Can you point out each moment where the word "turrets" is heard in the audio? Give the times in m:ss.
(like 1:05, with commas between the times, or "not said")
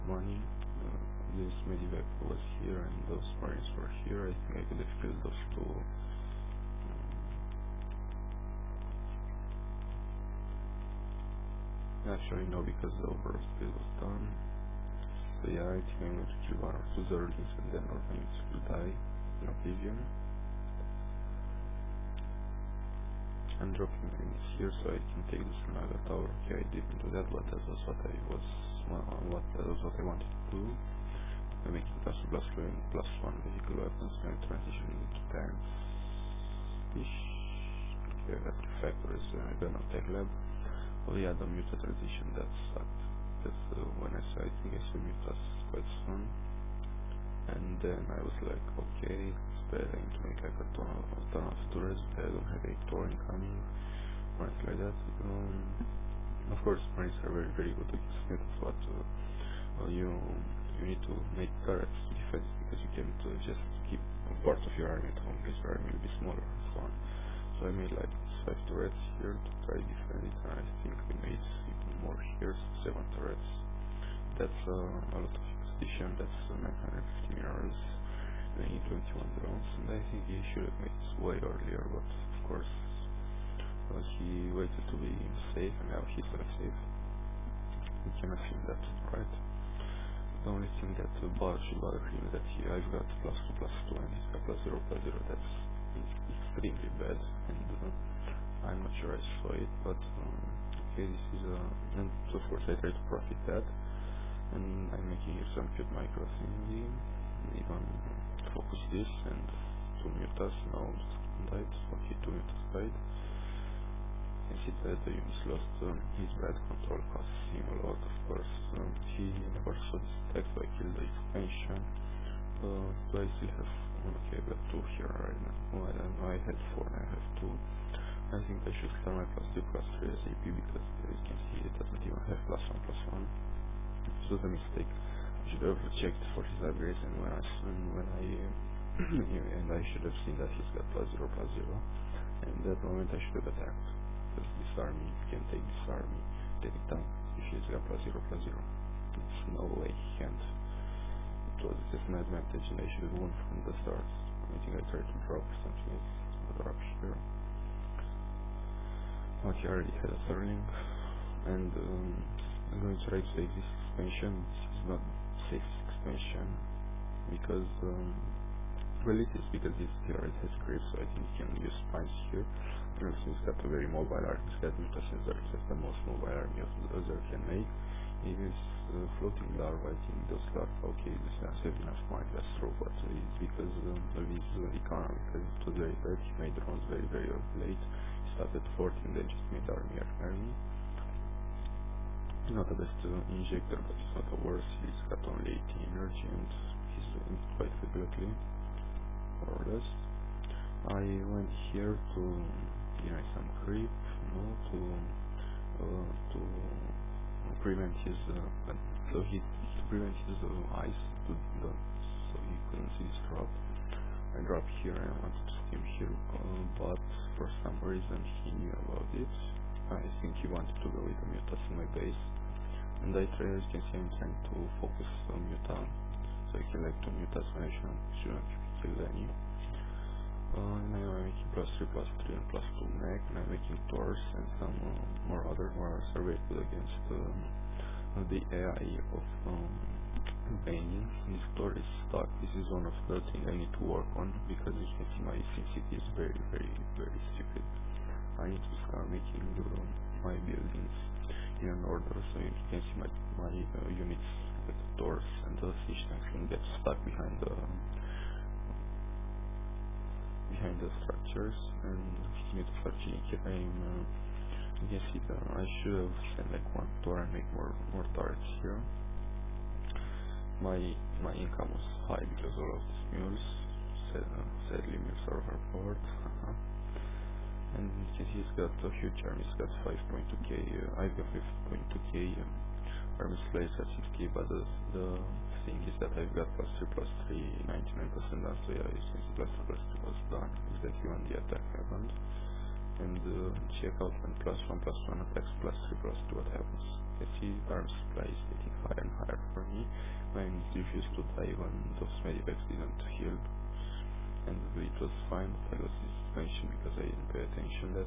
1:08, 1:13.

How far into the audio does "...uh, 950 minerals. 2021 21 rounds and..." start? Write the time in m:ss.
1:16.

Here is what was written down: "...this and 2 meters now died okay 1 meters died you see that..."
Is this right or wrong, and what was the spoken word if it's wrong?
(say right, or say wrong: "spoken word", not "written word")
wrong: "2", not "1".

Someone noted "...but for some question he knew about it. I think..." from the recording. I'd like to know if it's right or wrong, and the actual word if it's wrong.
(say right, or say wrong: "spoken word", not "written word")
wrong: "reason", not "question".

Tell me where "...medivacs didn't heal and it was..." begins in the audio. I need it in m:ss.
5:02.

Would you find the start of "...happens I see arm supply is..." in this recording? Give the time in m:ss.
4:56.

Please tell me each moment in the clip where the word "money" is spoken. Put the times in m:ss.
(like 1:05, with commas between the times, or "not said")
0:00.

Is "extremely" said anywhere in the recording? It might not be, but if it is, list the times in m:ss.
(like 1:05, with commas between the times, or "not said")
1:35.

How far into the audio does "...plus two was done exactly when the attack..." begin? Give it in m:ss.
4:49.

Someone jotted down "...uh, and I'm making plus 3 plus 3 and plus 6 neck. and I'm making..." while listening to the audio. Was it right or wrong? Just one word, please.
wrong.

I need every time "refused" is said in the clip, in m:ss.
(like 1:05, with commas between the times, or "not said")
5:00.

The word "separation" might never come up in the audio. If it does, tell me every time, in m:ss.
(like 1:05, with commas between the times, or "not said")
not said.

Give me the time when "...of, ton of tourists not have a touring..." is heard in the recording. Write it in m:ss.
0:50.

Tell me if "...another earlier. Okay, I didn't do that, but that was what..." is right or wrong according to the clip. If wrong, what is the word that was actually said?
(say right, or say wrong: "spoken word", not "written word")
wrong: "tower", not "earlier".